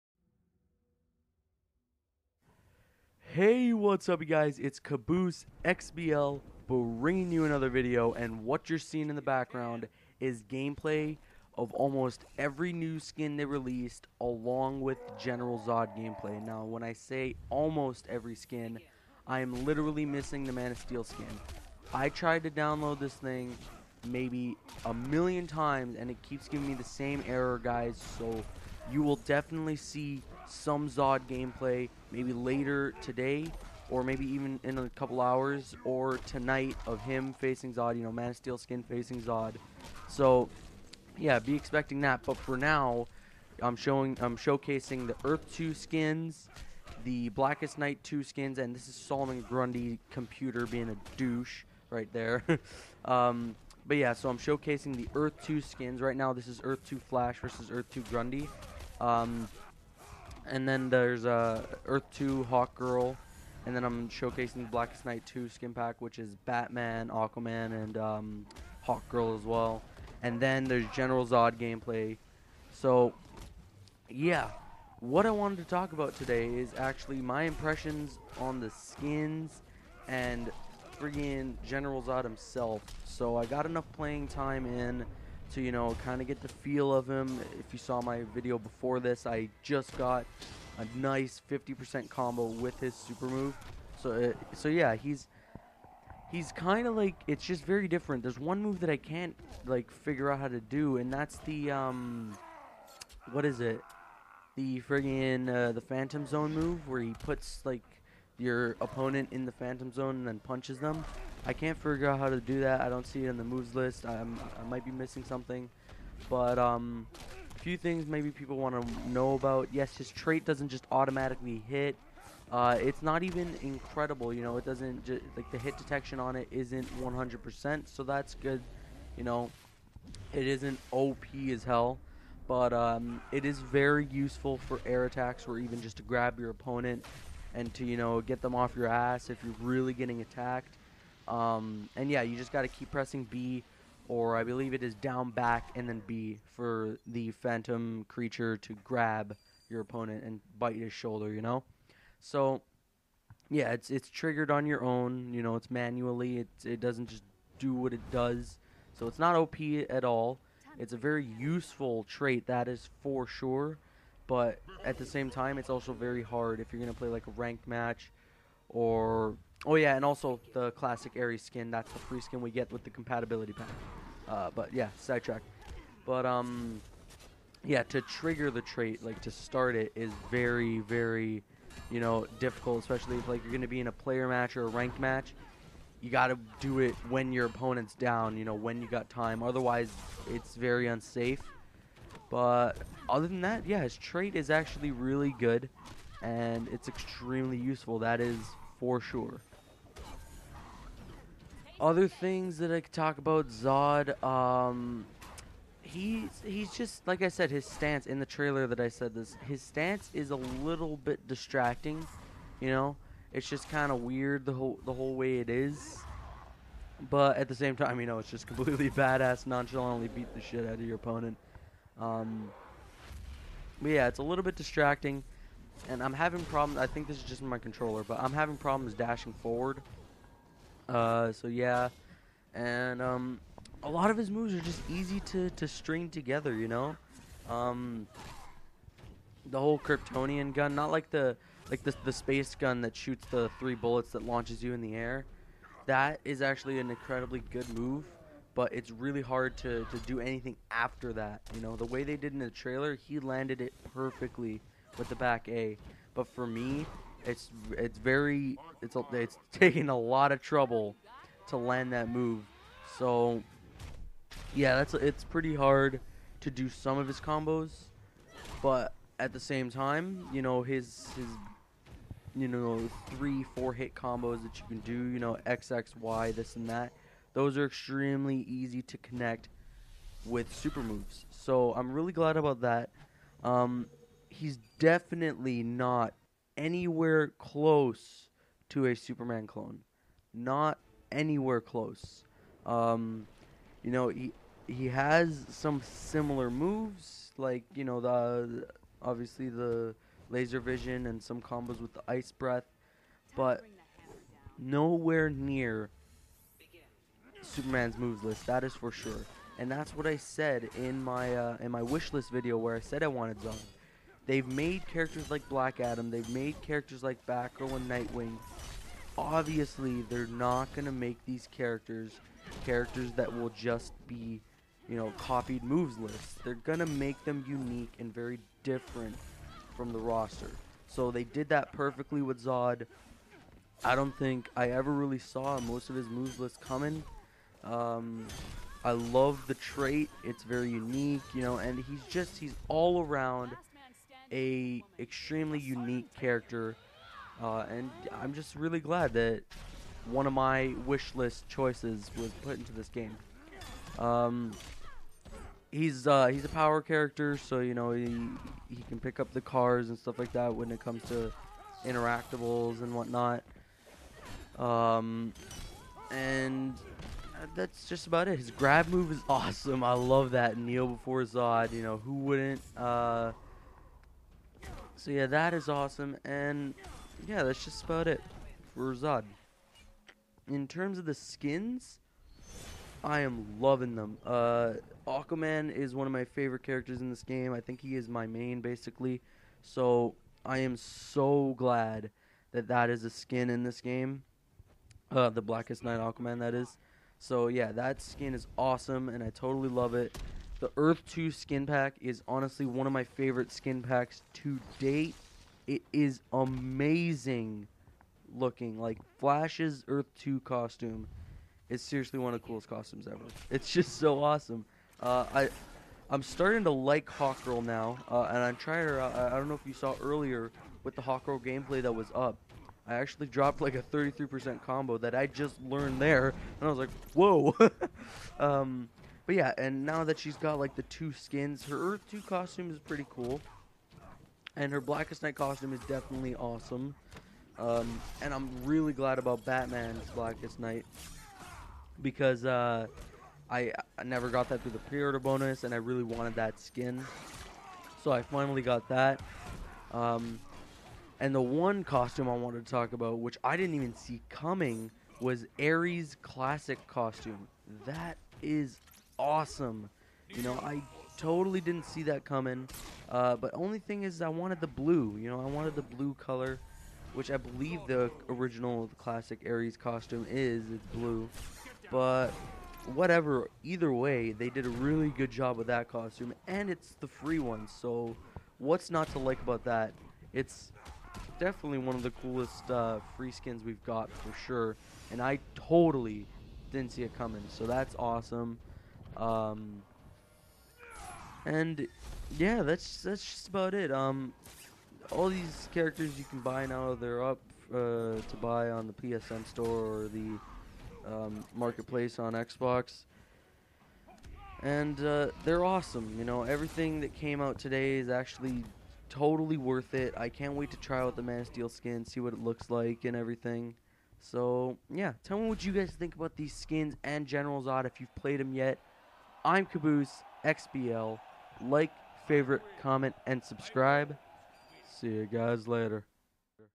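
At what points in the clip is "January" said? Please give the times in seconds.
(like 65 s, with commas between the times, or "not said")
not said.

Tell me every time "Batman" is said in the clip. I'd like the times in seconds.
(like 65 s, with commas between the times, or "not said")
66 s, 439 s.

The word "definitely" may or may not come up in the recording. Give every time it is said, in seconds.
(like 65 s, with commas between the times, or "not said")
29 s, 284 s, 435 s, 481 s.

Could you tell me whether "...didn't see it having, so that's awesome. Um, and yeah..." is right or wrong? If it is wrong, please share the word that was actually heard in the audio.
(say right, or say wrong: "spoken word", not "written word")
wrong: "coming", not "having".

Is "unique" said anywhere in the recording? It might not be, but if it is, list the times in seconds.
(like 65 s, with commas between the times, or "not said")
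327 s, 340 s, 345 s.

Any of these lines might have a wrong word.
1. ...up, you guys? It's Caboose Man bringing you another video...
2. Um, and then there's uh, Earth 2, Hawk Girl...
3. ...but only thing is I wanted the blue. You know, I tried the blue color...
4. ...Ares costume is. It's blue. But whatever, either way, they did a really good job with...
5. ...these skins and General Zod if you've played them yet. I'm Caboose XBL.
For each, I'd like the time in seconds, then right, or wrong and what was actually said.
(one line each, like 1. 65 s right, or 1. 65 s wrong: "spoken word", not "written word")
1. 4 s wrong: "XBL", not "Man"
2. 59 s right
3. 463 s wrong: "wanted", not "tried"
4. 469 s right
5. 516 s right.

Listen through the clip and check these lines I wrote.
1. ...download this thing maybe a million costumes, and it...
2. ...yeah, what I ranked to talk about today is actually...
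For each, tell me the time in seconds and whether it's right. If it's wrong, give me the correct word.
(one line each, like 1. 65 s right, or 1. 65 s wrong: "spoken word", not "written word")
1. 22 s wrong: "times", not "costumes"
2. 74 s wrong: "wanted", not "ranked".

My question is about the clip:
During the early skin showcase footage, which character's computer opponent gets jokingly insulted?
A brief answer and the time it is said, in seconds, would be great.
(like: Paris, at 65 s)
Solomon Grundy, at 48 s.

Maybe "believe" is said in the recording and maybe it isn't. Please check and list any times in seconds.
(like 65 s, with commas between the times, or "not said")
144 s, 467 s.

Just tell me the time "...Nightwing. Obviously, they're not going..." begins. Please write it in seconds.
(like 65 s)
317 s.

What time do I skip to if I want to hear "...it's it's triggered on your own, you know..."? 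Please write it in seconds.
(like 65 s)
153 s.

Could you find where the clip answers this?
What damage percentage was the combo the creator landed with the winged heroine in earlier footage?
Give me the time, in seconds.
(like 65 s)
423 s.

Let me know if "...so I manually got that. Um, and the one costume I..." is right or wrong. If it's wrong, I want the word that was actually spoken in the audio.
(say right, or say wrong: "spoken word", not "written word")
wrong: "finally", not "manually".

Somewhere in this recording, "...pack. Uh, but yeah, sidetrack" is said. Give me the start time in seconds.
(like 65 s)
173 s.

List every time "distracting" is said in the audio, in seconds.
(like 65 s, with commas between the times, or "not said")
211 s, 224 s.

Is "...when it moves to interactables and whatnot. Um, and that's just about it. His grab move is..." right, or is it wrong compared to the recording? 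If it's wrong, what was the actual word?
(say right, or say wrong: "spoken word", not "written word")
wrong: "comes", not "moves".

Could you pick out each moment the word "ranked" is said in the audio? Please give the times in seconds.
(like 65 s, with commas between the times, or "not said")
167 s, 184 s.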